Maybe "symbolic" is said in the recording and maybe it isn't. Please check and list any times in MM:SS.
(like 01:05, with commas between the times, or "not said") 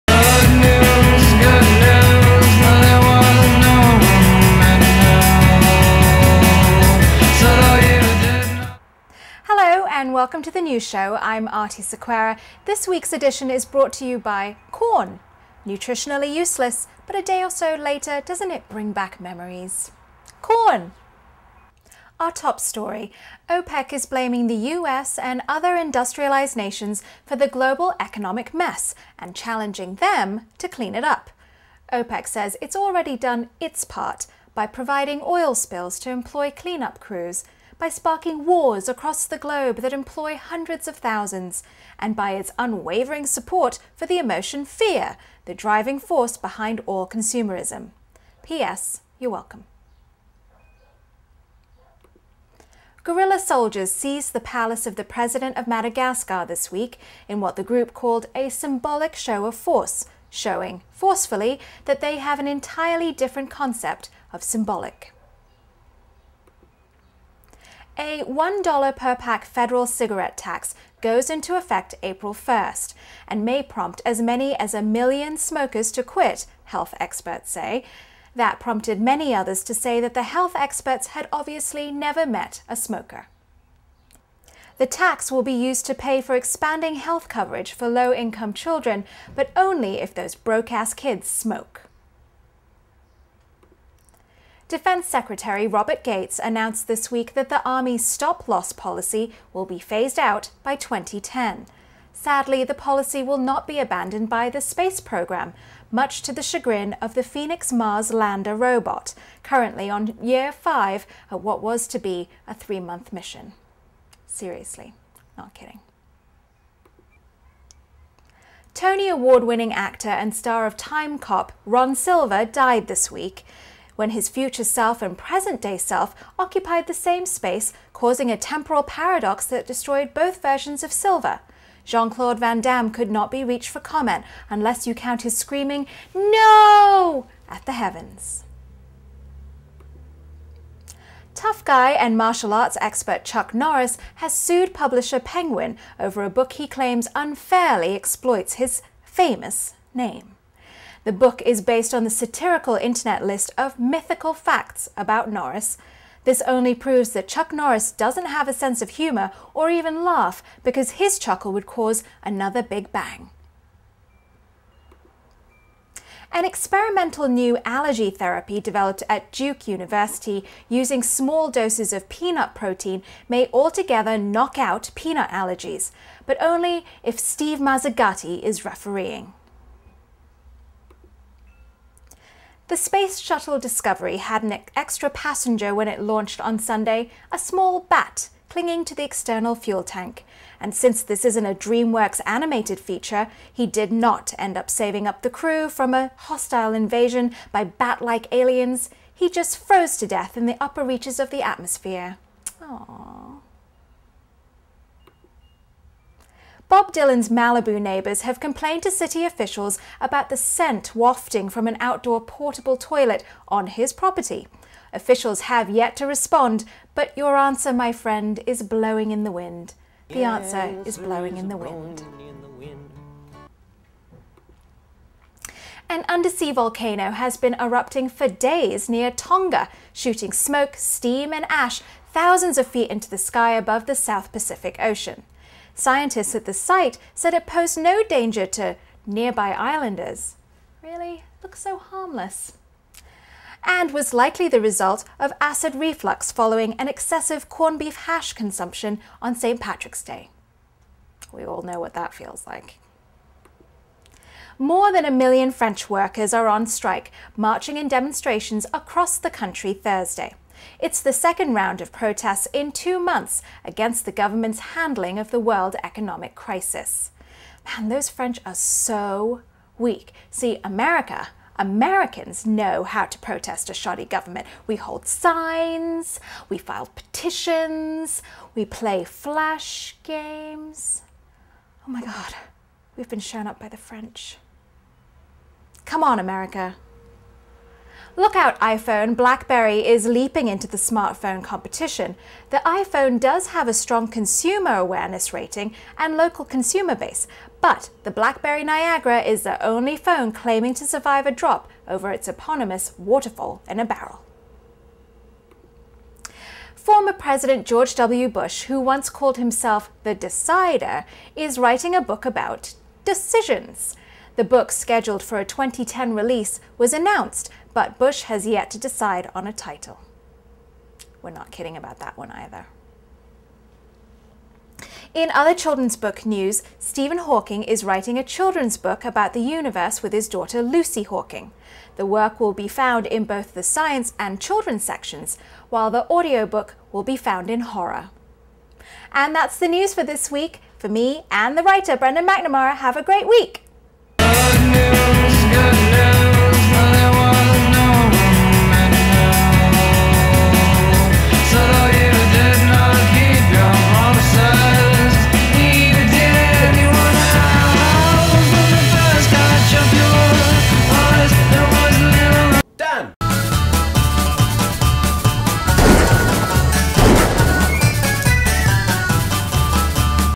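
00:58, 01:04.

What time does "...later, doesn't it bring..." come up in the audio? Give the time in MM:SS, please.
00:17.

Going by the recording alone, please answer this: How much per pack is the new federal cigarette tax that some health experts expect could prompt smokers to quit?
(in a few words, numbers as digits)
$1.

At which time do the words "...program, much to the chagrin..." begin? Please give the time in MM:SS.
01:45.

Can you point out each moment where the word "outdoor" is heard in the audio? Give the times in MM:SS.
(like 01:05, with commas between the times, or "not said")
03:31.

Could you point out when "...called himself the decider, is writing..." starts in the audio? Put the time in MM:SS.
05:09.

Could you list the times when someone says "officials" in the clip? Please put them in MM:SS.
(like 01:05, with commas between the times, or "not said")
03:29, 03:34.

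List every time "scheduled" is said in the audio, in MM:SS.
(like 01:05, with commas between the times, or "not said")
05:14.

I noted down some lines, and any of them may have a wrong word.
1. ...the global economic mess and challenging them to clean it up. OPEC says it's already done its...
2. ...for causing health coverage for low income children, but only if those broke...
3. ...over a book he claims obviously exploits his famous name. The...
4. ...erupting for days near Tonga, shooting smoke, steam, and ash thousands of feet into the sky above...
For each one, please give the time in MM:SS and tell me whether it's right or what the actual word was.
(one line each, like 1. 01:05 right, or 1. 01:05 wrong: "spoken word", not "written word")
1. 00:27 right
2. 01:26 wrong: "expanding", not "causing"
3. 02:25 wrong: "unfairly", not "obviously"
4. 03:47 right.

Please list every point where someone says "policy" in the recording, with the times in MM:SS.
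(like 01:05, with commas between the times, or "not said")
01:38, 01:42.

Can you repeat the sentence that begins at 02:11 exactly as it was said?
Jean Claude Van Damme could not be reached for comment unless you count his screaming, No!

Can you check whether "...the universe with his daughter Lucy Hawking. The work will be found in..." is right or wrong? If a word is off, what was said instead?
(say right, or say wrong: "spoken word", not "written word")
right.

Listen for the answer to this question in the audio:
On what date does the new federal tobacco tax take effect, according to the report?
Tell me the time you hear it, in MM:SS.
01:12.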